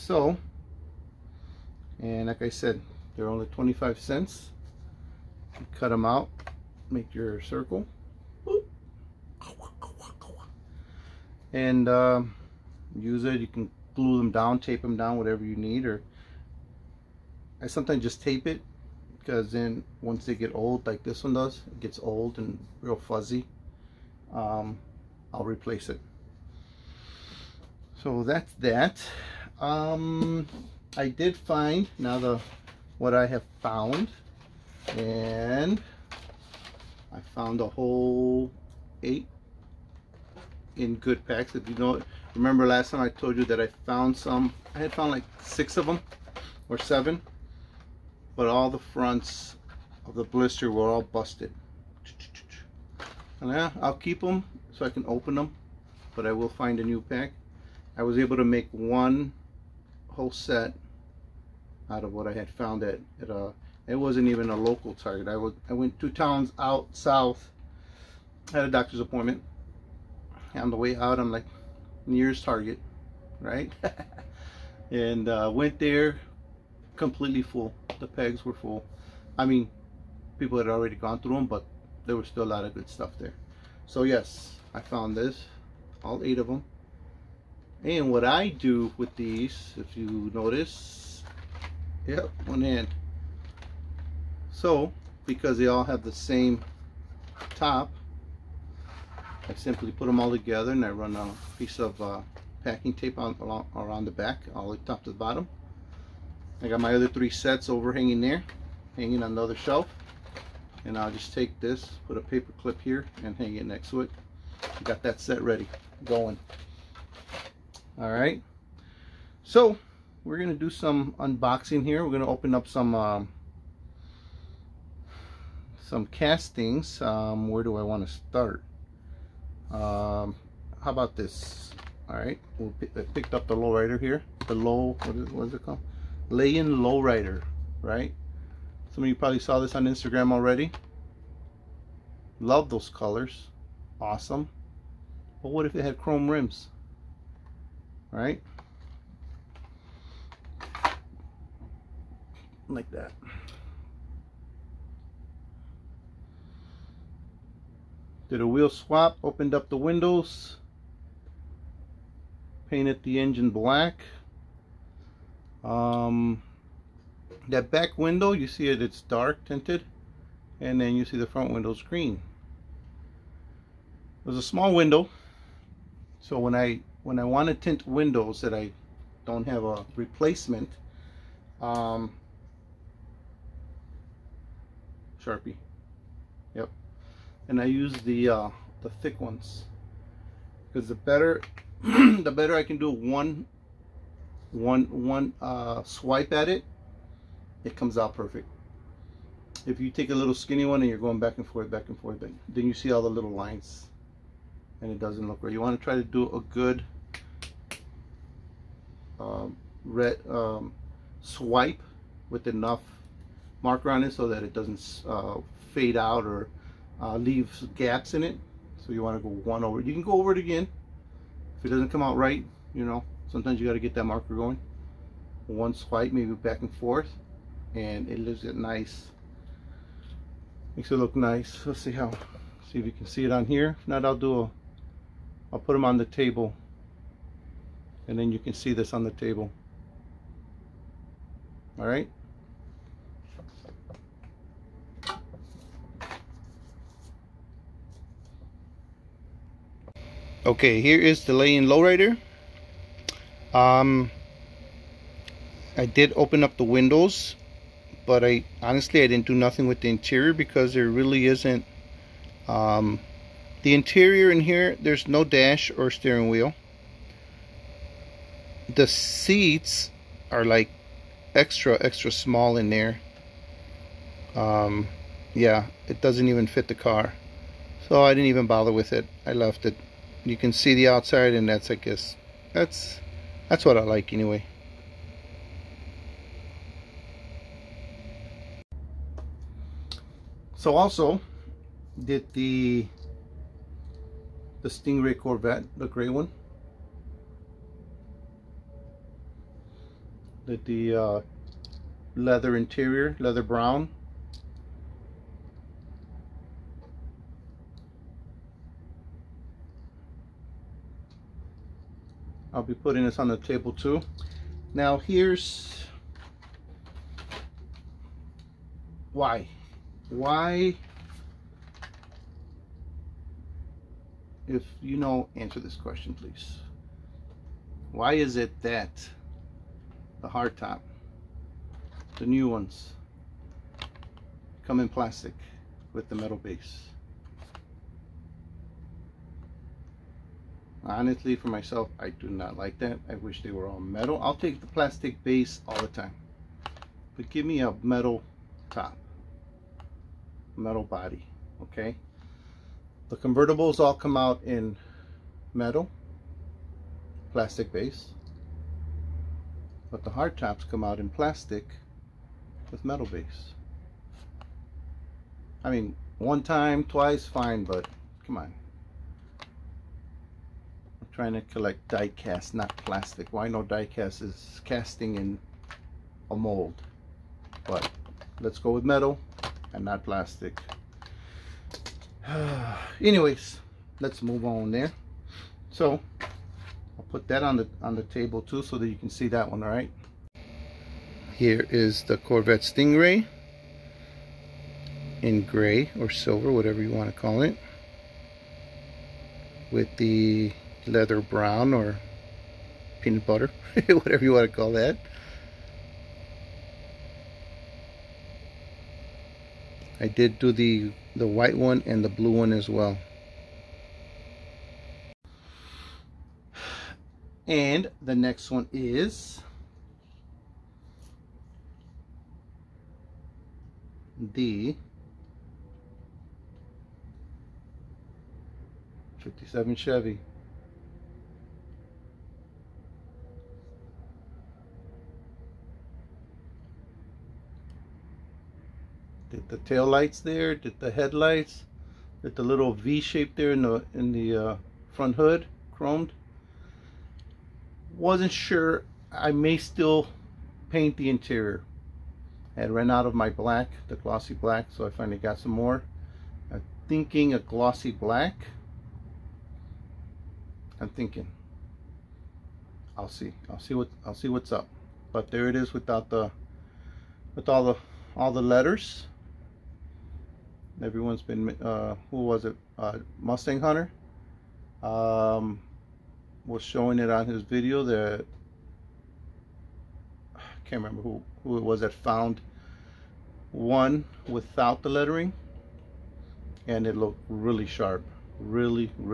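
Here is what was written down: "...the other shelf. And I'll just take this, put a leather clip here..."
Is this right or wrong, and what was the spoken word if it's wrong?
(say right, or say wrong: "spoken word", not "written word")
wrong: "paper", not "leather".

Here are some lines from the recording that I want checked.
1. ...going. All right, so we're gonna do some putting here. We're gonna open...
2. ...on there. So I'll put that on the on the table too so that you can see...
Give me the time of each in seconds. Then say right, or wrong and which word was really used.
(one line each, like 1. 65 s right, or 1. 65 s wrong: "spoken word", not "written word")
1. 116 s wrong: "unboxing", not "putting"
2. 384 s right.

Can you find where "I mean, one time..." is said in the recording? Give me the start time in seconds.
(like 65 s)
365 s.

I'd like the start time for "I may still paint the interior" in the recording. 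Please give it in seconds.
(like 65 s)
449 s.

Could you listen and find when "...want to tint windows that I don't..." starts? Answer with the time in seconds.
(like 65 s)
177 s.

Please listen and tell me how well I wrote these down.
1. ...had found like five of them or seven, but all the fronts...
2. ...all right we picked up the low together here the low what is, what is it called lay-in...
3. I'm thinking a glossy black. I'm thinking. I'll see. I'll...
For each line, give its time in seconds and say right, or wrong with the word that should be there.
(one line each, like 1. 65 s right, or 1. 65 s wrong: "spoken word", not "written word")
1. 44 s wrong: "six", not "five"
2. 132 s wrong: "rider", not "together"
3. 456 s right.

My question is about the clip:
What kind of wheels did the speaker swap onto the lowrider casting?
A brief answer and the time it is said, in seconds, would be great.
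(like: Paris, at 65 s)
chrome rims, at 145 s.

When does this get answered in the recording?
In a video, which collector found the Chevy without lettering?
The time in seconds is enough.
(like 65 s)
473 s.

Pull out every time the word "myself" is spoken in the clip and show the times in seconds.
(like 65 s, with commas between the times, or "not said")
341 s.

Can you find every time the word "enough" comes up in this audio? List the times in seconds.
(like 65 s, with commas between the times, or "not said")
212 s.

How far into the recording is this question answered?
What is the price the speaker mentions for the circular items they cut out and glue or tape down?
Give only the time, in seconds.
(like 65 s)
3 s.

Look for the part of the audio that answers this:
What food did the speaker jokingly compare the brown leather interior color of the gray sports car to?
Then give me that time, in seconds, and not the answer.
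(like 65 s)
403 s.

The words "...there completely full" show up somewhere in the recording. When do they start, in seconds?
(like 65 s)
75 s.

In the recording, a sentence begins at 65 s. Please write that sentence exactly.
I, was, I went two towns out south, had a doctor's appointment.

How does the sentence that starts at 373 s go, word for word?
Why not no die cast is casting in a mold.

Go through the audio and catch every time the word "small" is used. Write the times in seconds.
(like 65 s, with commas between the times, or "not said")
174 s, 272 s.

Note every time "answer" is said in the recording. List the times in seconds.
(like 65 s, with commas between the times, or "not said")
325 s.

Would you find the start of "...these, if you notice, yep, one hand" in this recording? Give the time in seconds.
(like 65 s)
89 s.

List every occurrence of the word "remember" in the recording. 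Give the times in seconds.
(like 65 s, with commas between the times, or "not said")
42 s, 480 s.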